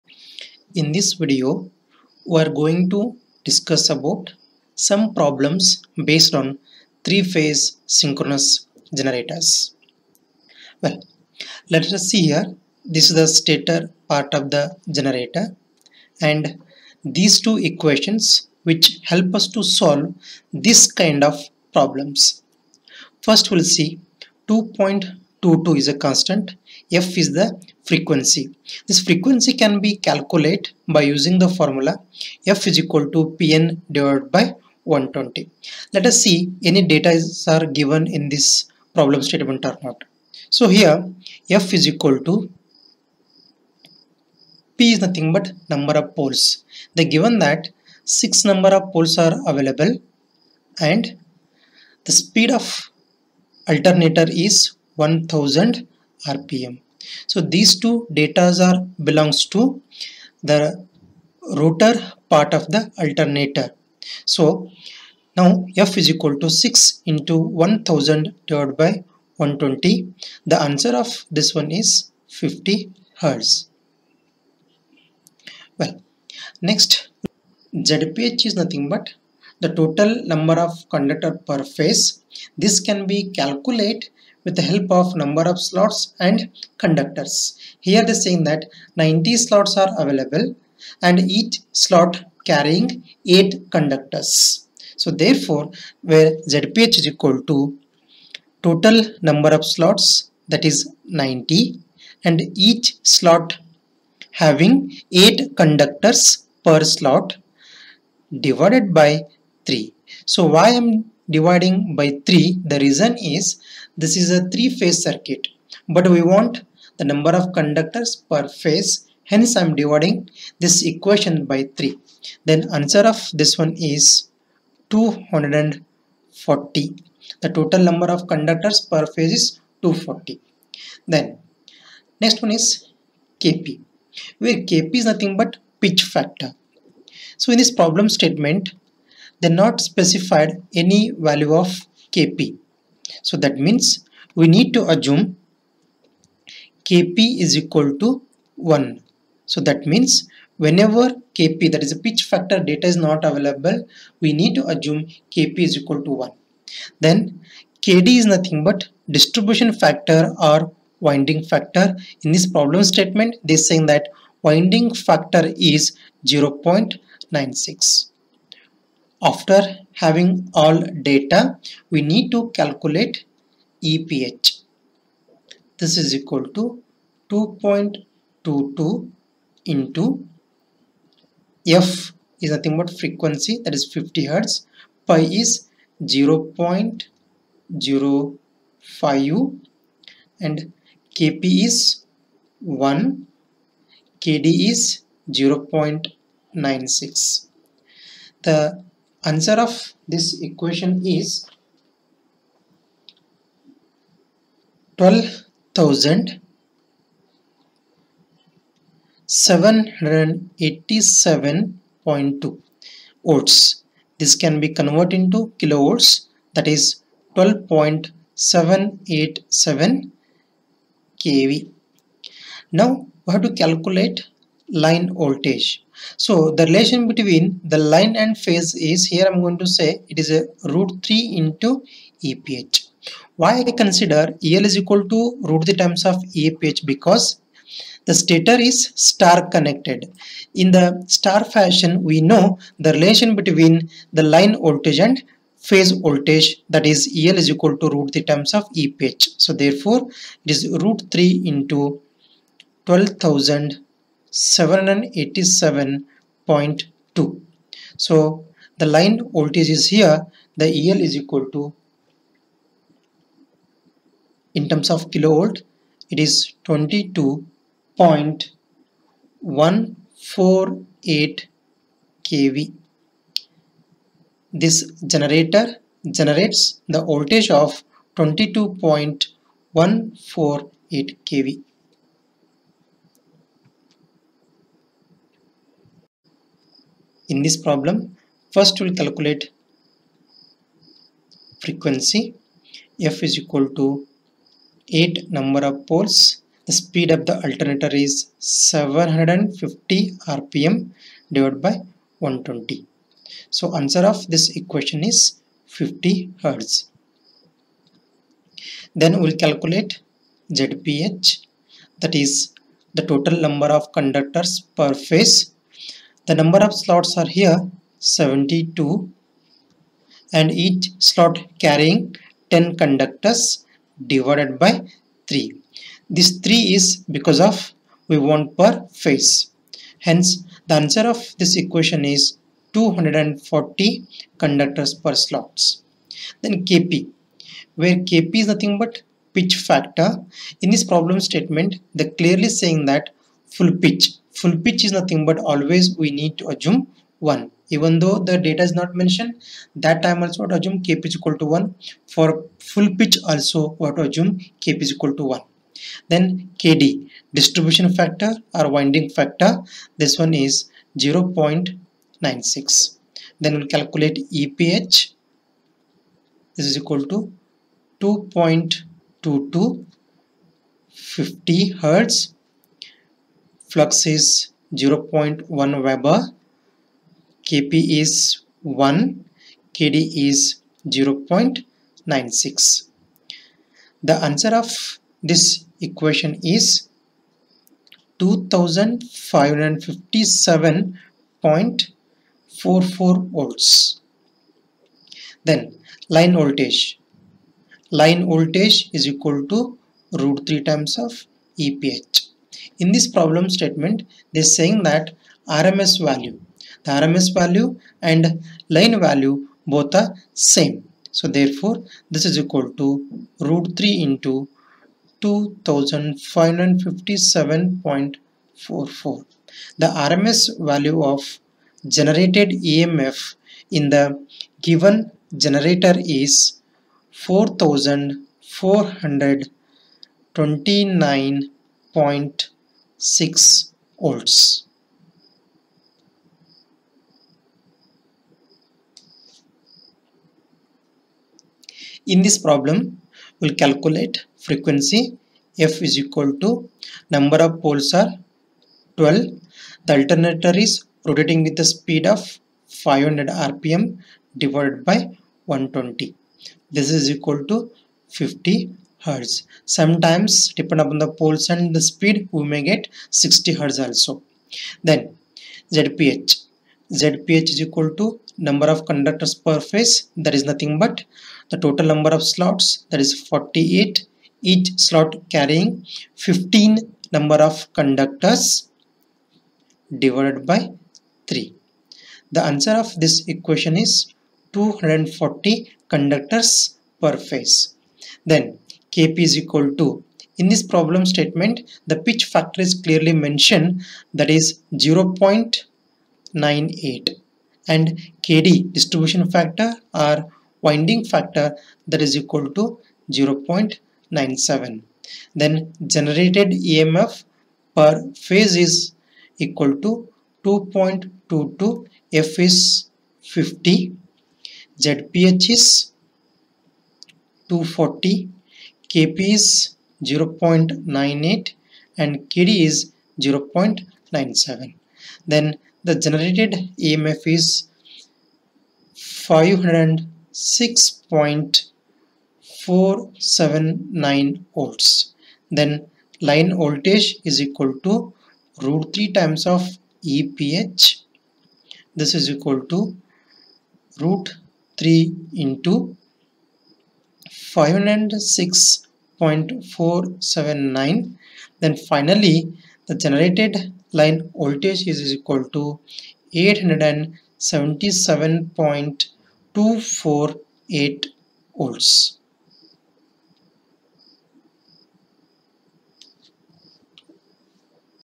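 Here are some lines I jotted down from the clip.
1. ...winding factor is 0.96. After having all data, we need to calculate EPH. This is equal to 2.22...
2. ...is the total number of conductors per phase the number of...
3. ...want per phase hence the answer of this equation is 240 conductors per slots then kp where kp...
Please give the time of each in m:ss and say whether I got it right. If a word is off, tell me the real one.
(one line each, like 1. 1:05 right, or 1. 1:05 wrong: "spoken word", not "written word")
1. 2:44 right
2. 5:12 right
3. 5:28 right.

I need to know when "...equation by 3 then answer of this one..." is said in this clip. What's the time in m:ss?
2:00.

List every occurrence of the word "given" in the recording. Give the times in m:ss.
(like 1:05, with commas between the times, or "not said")
0:37, 0:47, 7:04.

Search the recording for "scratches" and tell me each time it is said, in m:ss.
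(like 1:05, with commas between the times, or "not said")
not said.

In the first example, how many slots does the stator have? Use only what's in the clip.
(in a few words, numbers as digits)
90.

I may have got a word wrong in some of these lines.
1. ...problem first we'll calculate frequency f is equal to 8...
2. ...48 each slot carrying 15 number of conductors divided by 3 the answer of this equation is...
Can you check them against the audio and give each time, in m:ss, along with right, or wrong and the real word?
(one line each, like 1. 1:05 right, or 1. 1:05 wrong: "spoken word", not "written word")
1. 4:47 right
2. 7:53 right.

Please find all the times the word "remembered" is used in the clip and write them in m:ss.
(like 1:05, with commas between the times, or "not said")
not said.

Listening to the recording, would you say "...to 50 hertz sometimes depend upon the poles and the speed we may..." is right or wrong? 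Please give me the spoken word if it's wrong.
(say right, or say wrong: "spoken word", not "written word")
right.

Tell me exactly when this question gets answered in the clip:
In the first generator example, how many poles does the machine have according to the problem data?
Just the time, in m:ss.
0:48.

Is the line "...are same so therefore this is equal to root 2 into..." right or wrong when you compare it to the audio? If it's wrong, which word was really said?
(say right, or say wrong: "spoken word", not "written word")
wrong: "3", not "2".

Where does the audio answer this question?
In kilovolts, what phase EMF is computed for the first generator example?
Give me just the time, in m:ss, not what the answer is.
3:37.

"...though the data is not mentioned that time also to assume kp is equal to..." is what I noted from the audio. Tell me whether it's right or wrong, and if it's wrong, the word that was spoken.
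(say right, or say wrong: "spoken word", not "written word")
right.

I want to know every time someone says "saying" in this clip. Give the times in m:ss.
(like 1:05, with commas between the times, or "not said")
1:28, 2:43, 5:42, 6:44.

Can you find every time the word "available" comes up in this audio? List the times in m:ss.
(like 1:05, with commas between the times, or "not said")
0:49, 1:30, 2:33.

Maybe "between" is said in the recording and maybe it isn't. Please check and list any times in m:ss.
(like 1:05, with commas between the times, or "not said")
3:47, 4:03.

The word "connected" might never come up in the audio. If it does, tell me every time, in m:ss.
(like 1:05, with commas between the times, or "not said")
3:59.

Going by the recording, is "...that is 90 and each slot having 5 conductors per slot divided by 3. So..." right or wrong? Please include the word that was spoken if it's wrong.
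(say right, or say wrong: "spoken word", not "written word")
wrong: "8", not "5".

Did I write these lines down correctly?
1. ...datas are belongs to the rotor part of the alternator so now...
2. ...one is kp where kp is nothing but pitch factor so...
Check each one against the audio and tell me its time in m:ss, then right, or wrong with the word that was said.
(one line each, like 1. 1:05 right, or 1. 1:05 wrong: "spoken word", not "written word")
1. 0:58 right
2. 2:12 right.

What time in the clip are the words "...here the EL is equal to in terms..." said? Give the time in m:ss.
4:19.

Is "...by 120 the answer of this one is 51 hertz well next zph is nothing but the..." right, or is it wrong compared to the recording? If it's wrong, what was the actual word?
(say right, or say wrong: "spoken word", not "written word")
wrong: "50", not "51".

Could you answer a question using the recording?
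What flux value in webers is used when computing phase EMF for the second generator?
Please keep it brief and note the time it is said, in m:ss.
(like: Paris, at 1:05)
0.1 Weber, at 6:14.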